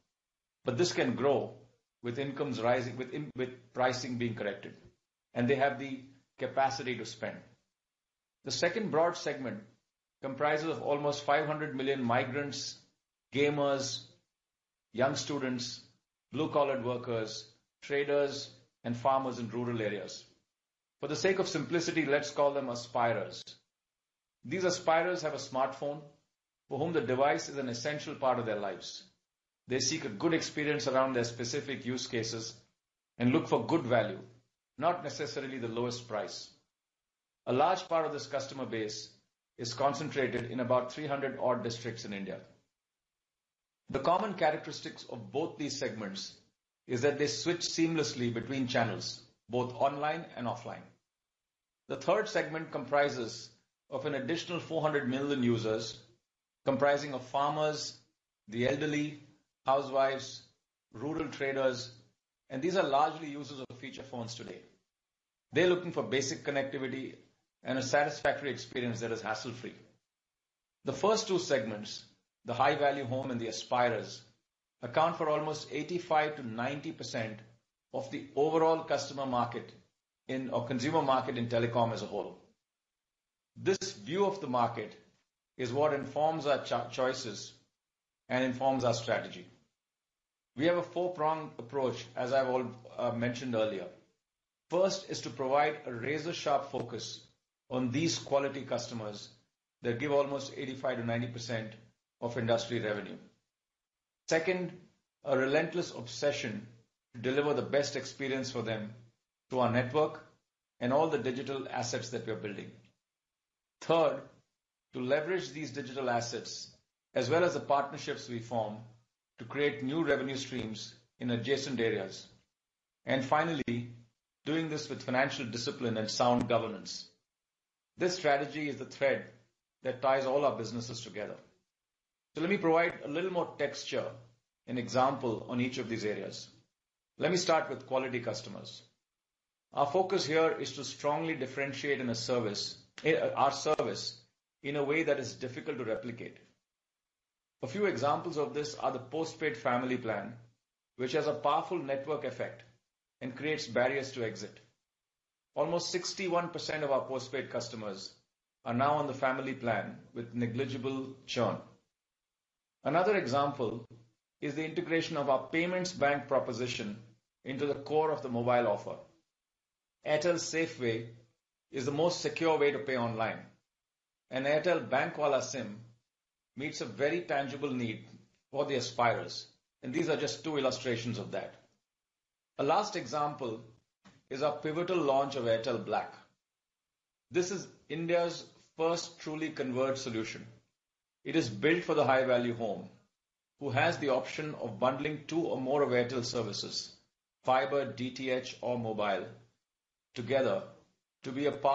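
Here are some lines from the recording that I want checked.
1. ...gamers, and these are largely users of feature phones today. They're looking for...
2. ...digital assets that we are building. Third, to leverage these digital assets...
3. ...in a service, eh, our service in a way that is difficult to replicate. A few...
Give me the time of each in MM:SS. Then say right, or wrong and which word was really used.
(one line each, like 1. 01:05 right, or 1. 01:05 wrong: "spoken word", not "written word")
1. 01:01 wrong: "traders", not "gamers"
2. 01:51 right
3. 02:21 right.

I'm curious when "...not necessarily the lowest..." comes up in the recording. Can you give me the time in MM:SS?
00:34.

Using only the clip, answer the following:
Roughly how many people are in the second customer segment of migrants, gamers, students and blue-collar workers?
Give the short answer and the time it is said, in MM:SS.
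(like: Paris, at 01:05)
500 million, at 00:11.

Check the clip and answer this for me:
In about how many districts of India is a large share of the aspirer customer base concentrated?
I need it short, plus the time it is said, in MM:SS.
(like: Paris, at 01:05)
300, at 00:40.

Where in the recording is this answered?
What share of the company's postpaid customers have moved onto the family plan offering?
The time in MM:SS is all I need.
02:35.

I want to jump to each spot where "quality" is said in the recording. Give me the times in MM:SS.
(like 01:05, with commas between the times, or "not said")
01:38, 02:17.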